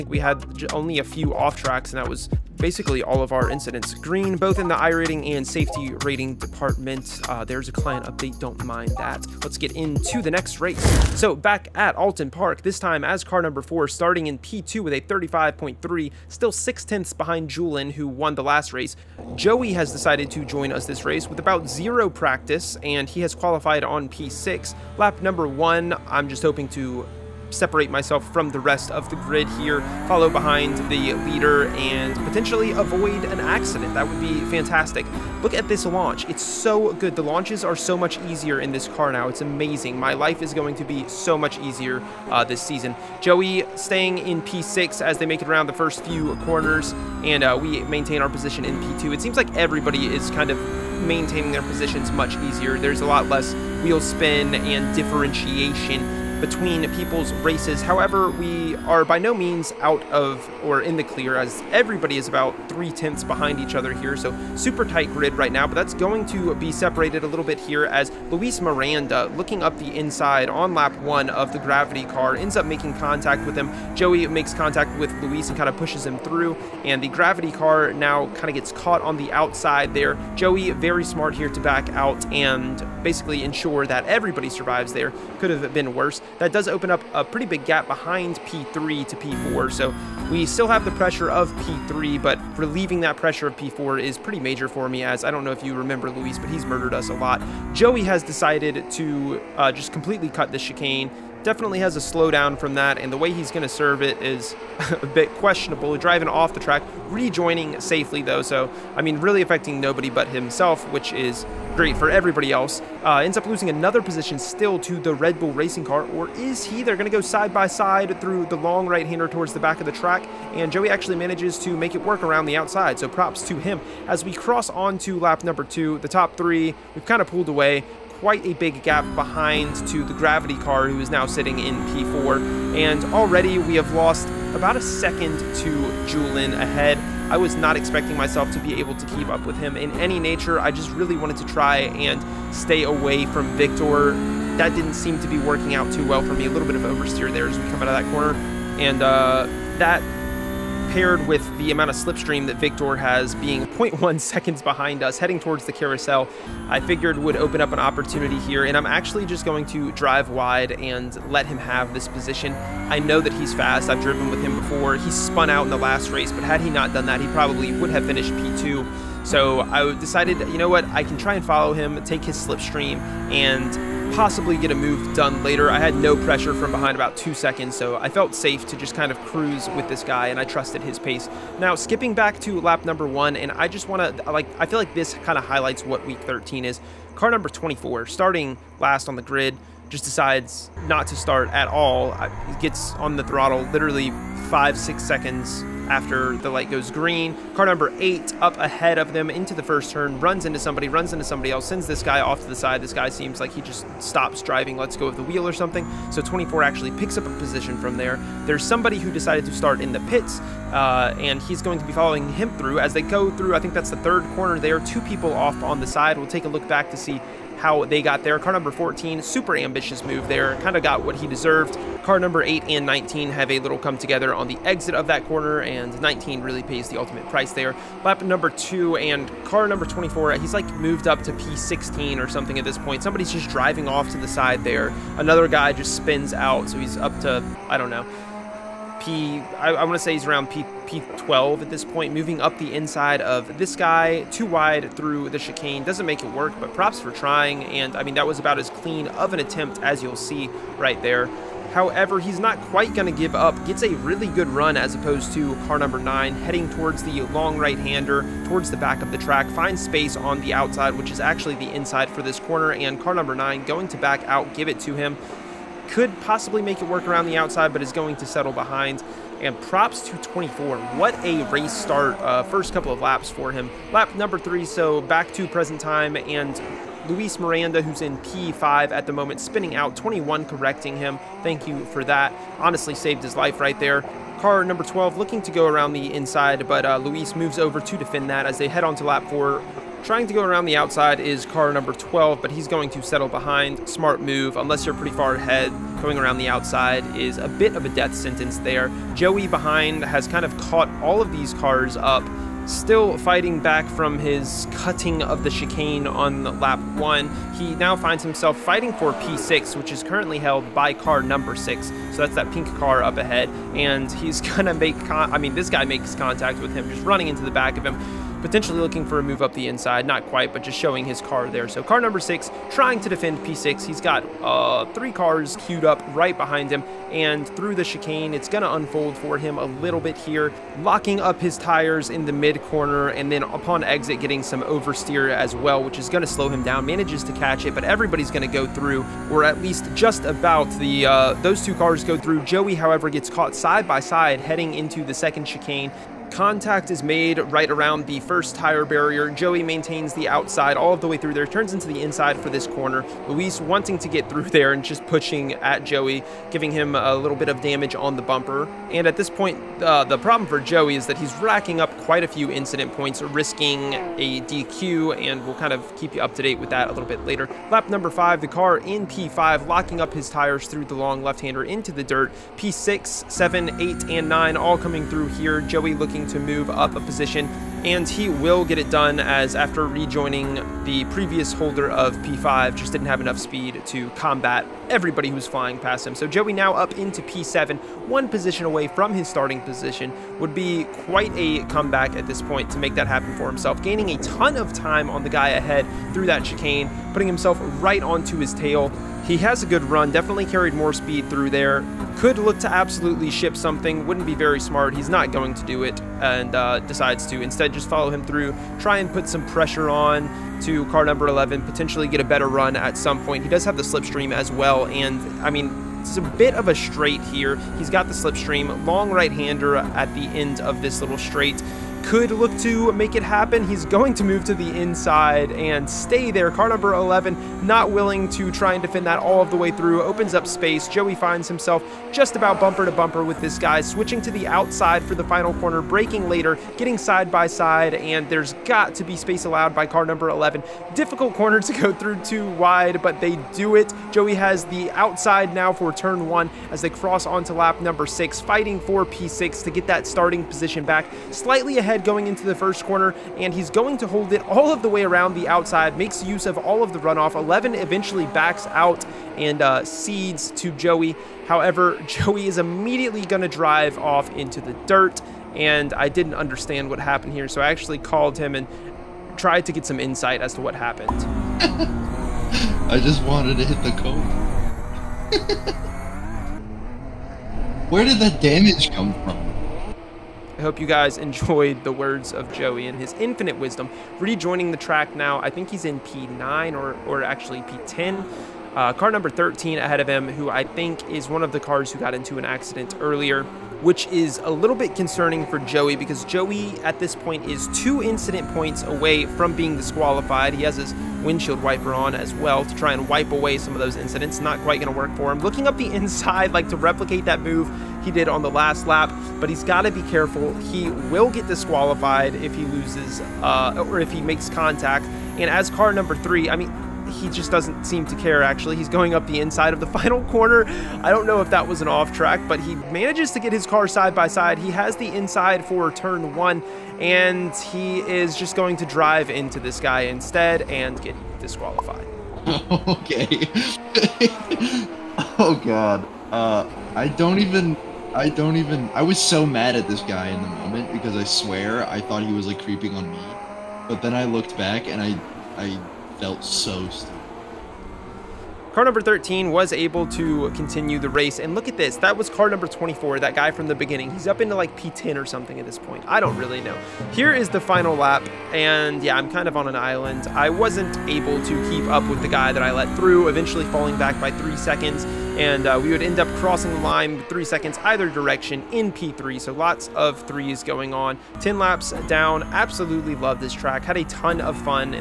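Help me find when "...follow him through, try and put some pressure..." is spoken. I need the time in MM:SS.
06:47.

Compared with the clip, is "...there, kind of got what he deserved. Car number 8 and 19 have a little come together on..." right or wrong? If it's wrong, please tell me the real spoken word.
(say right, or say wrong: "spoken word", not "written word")
right.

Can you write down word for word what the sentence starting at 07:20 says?
Difficult corner to go through too wide, but they do it.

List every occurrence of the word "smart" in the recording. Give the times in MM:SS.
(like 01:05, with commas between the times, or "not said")
01:21, 04:53, 06:44.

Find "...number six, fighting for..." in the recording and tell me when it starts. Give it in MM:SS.
07:27.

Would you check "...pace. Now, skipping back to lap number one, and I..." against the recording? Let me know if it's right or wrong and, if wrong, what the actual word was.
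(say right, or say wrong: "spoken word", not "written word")
right.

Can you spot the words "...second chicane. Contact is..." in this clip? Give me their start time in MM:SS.
05:45.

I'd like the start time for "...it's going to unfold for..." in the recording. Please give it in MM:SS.
05:28.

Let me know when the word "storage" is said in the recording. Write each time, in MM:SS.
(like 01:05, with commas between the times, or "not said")
not said.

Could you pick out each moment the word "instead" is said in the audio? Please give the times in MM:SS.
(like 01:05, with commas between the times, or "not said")
06:47, 08:50.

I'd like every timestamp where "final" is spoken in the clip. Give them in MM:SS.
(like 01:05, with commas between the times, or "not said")
07:15, 08:39, 09:17.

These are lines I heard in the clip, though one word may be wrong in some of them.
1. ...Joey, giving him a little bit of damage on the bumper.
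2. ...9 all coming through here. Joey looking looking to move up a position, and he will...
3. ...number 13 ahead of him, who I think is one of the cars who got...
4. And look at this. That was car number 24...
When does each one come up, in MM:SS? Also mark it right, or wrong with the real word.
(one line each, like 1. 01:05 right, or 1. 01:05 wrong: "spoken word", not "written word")
1. 05:55 right
2. 06:14 right
3. 08:09 right
4. 09:11 right.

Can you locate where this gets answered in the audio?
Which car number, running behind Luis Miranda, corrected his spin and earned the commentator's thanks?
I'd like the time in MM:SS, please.
04:39.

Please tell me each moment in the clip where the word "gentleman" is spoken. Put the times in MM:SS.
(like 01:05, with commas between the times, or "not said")
not said.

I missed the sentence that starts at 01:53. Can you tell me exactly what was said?
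Uh, ends up losing another position still to the Red Bull racing car, or is he?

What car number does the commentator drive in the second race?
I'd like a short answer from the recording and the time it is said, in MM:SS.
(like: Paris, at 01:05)
4, at 00:13.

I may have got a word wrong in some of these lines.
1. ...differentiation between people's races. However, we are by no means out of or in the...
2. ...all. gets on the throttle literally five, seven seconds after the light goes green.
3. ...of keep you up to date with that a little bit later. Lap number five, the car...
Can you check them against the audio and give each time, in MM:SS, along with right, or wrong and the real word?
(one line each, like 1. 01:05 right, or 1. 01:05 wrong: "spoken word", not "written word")
1. 00:54 right
2. 03:11 wrong: "six", not "seven"
3. 06:05 right.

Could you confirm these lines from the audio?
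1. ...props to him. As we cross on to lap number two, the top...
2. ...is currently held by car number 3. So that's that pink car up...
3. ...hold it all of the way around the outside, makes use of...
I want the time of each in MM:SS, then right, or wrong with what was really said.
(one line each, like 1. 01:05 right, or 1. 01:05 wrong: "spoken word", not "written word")
1. 02:03 right
2. 05:09 wrong: "6", not "3"
3. 07:34 right.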